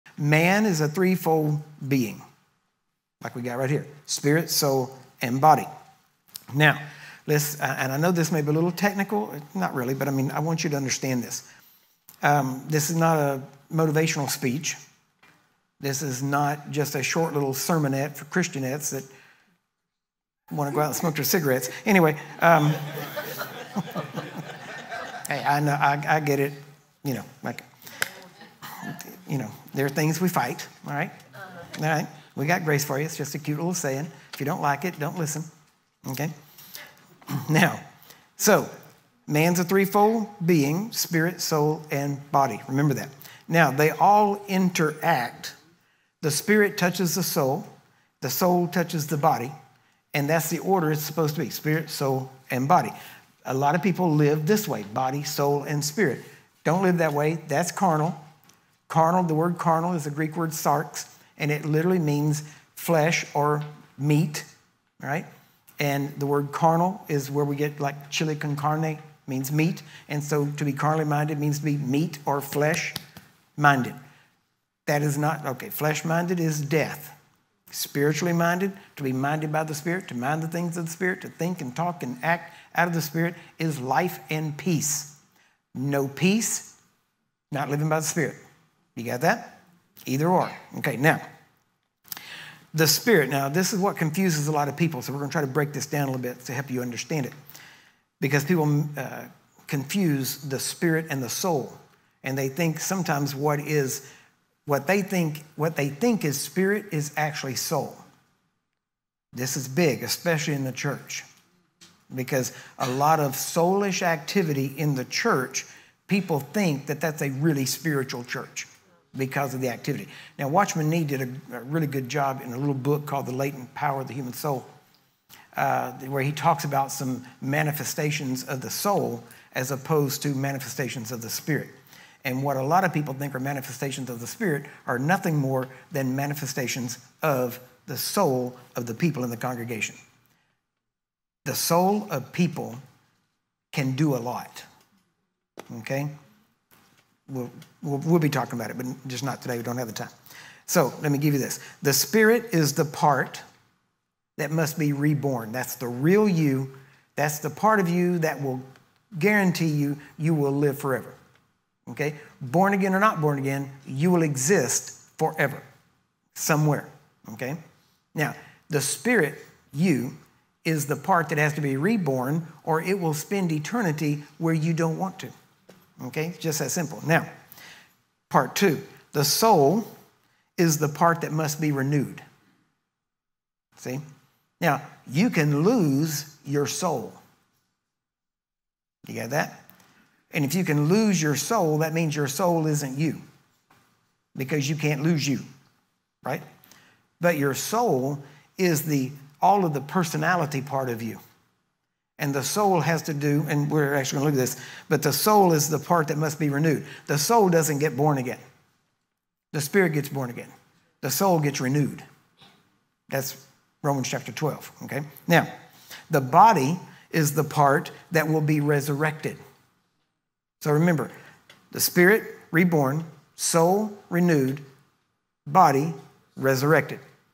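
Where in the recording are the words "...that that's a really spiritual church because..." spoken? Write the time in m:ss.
1:56.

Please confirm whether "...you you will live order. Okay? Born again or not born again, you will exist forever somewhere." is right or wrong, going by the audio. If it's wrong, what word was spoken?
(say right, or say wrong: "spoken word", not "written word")
wrong: "forever", not "order".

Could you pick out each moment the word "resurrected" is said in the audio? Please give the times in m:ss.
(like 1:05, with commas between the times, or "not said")
3:38, 3:46.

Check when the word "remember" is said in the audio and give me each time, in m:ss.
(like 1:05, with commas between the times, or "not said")
0:42, 3:40.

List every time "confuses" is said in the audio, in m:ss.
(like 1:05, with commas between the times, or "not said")
1:33, 1:39.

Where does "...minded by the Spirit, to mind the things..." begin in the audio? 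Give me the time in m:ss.
1:19.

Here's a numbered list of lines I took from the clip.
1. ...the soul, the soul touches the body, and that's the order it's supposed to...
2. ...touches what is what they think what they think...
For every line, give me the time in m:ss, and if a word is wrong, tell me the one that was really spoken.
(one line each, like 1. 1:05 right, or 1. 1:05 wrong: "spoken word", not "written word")
1. 0:47 right
2. 1:42 wrong: "sometimes", not "touches".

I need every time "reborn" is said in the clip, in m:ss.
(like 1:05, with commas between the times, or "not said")
2:34, 2:51, 3:42.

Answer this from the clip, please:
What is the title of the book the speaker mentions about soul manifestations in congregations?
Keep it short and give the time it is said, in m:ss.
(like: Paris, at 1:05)
The Latent Power of the Human Soul, at 2:03.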